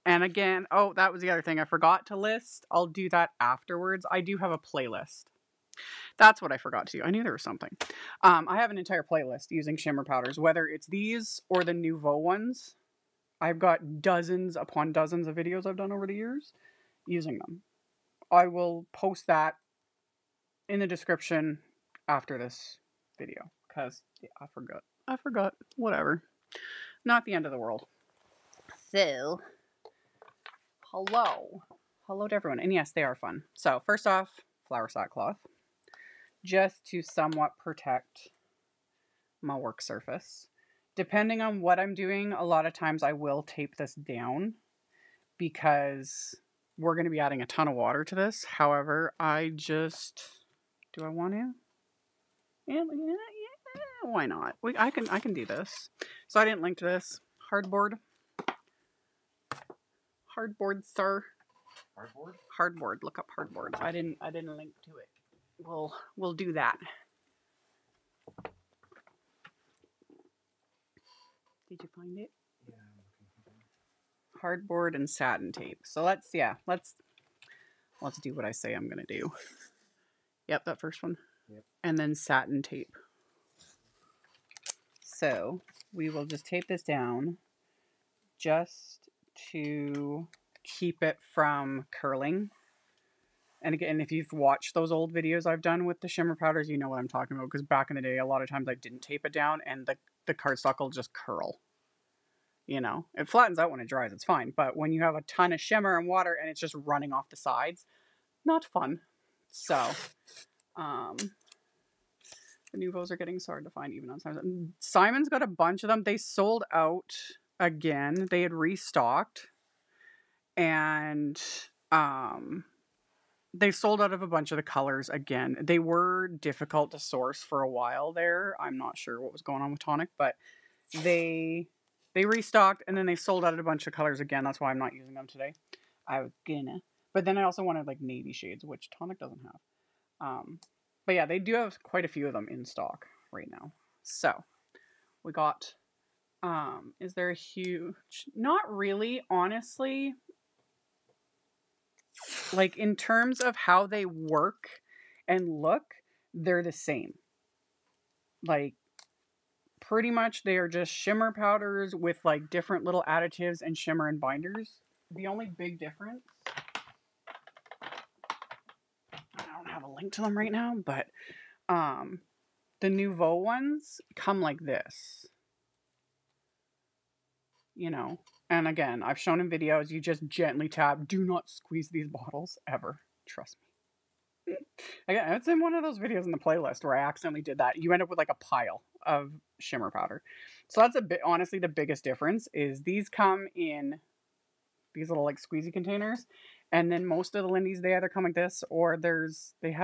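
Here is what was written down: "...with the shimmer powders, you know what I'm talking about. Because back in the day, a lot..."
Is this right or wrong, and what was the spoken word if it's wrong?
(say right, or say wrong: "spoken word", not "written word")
right.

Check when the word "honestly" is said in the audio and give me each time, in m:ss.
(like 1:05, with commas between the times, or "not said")
2:29, 3:11.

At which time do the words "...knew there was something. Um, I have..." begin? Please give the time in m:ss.
0:07.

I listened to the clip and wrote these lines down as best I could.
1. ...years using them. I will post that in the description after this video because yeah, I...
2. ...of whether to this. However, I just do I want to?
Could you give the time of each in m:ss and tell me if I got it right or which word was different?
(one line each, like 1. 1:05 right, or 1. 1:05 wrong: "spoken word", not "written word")
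1. 0:16 right
2. 0:47 wrong: "water", not "whether".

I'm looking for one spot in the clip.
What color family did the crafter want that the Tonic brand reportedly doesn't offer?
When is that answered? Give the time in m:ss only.
2:18.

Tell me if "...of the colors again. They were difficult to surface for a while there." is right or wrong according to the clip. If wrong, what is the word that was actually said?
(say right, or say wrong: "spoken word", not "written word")
wrong: "source", not "surface".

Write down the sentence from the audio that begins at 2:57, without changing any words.
You know, and again, I've shown in videos, you just gently tap.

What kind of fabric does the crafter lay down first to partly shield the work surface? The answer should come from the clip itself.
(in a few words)
Flour sack cloth.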